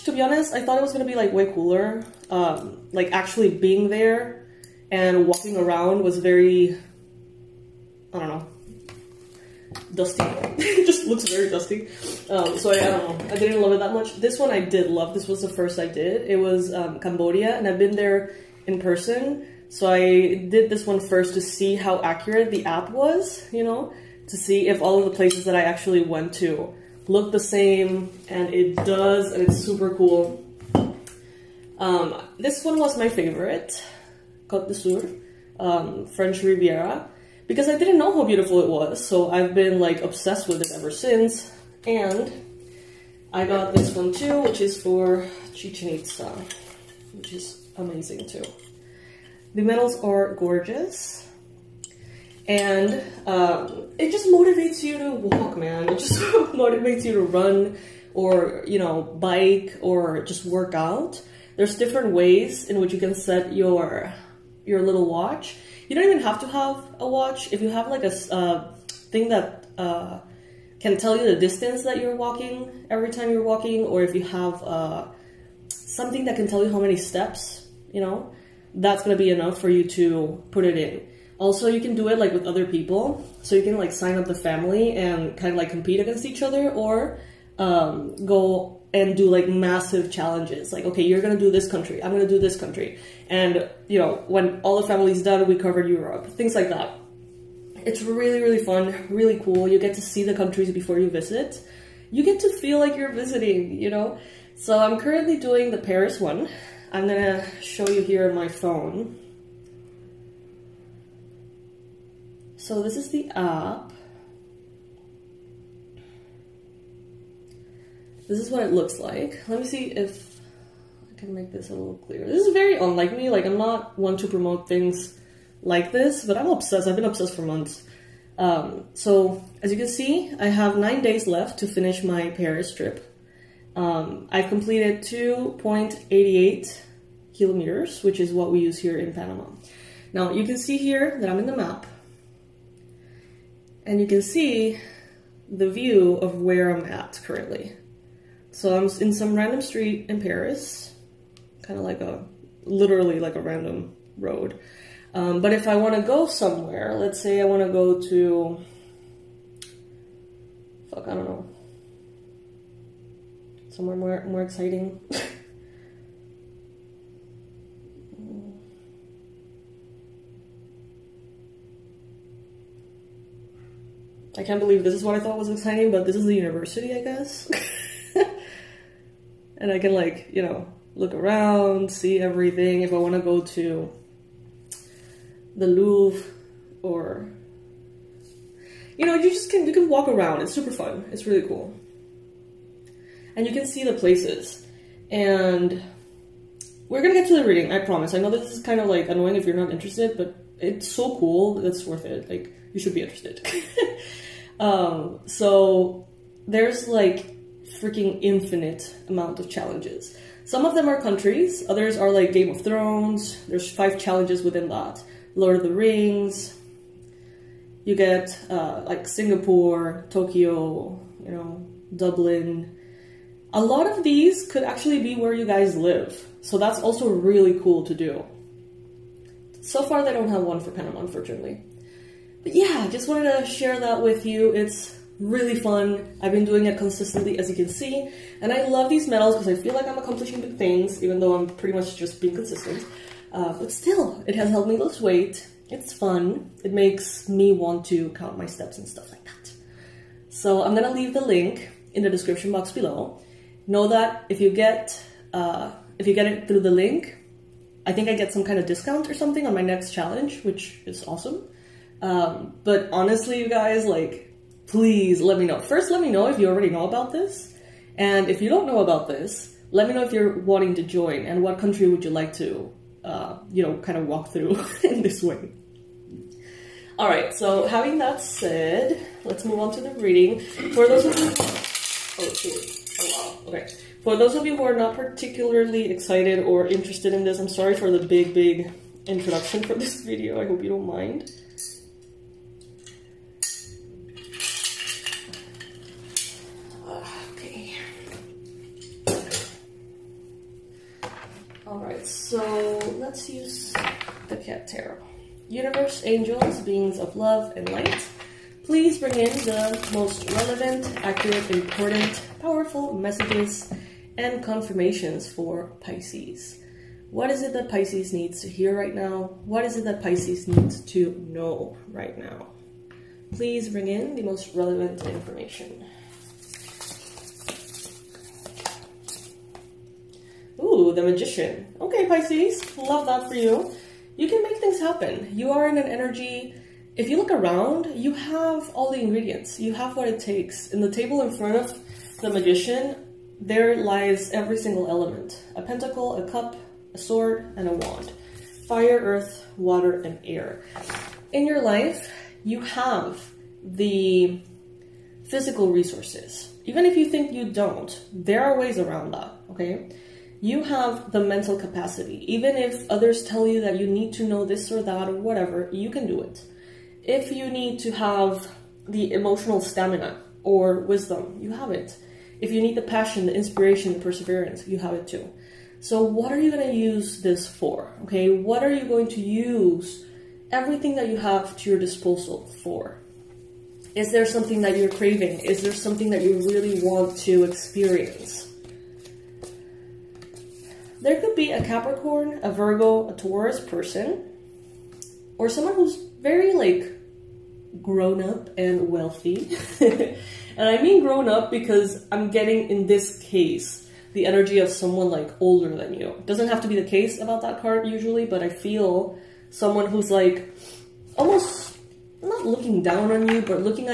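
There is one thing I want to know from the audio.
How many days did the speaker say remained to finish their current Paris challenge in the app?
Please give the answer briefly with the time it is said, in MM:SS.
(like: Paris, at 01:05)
9, at 02:10.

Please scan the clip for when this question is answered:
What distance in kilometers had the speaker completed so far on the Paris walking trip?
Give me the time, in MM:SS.
02:15.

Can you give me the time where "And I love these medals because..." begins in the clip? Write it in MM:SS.
03:58.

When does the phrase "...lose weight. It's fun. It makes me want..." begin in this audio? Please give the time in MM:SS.
04:04.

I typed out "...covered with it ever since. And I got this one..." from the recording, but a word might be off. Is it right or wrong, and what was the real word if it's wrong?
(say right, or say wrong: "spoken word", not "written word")
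wrong: "obsessed", not "covered".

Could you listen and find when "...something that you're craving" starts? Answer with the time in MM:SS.
06:24.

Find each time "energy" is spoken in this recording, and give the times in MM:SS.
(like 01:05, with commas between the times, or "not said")
05:35, 06:44.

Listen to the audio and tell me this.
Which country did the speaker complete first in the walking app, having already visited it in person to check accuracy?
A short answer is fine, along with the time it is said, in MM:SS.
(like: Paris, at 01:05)
Cambodia, at 00:16.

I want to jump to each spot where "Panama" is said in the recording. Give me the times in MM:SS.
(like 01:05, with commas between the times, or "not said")
02:19, 03:50.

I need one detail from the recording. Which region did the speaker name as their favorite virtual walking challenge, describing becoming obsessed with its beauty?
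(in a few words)
Côte d'Azur.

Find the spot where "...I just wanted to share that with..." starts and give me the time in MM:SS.
03:52.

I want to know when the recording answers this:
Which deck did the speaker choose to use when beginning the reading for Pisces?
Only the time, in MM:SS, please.
05:04.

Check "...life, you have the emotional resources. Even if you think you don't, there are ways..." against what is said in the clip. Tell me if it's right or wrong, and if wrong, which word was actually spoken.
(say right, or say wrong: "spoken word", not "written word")
wrong: "physical", not "emotional".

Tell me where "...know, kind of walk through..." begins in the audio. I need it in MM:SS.
04:33.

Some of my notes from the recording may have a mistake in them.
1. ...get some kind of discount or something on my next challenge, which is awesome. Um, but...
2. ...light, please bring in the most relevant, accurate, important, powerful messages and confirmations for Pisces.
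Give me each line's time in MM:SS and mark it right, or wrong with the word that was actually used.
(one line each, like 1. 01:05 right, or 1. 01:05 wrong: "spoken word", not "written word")
1. 04:18 right
2. 05:07 right.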